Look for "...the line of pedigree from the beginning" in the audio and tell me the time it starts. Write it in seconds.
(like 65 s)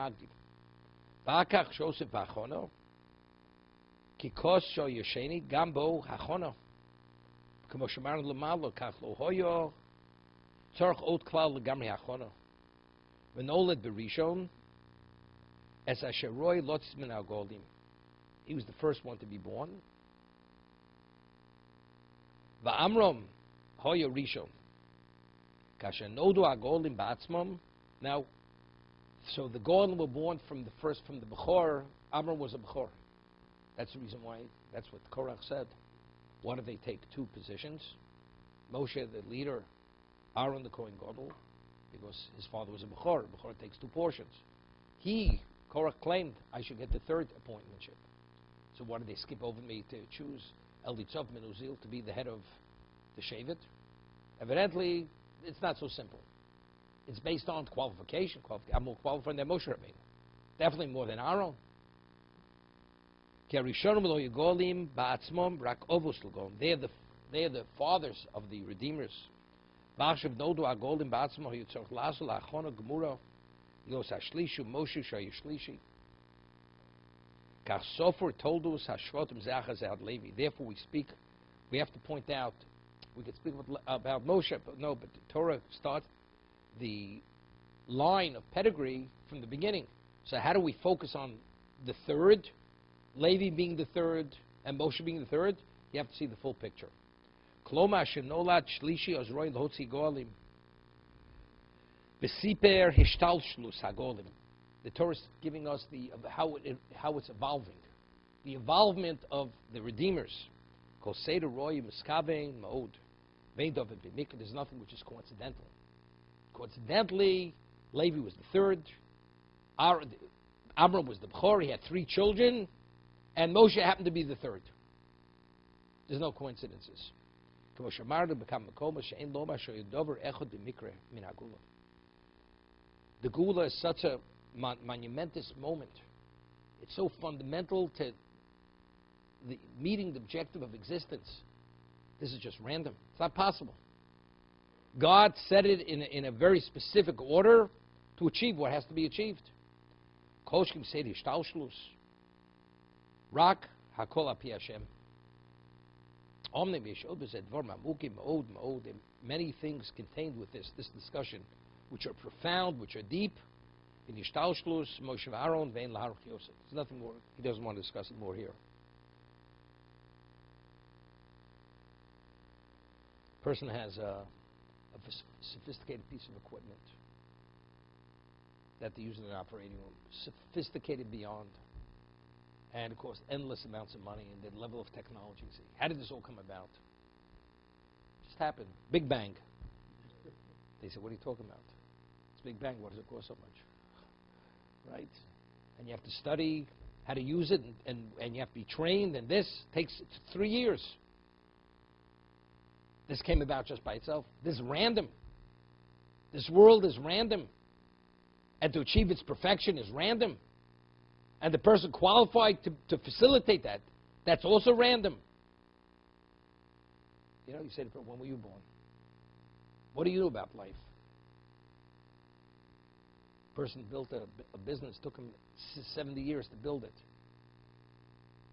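86 s.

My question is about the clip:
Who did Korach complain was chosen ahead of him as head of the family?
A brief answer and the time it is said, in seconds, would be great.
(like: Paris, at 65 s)
Elitzov Menuzil, at 50 s.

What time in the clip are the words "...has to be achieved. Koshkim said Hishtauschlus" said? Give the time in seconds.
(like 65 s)
148 s.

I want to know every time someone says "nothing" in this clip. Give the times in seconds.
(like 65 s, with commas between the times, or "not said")
114 s, 166 s.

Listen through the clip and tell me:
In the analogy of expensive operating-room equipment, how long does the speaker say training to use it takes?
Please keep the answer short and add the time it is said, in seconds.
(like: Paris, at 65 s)
3 years, at 200 s.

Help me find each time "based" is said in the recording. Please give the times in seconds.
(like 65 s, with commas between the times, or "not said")
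57 s.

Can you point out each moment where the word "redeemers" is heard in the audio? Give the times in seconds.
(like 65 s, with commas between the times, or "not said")
68 s, 109 s.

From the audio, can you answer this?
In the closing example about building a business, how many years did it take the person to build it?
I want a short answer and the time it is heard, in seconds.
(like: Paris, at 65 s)
70, at 225 s.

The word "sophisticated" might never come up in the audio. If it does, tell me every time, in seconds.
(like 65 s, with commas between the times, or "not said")
175 s, 180 s.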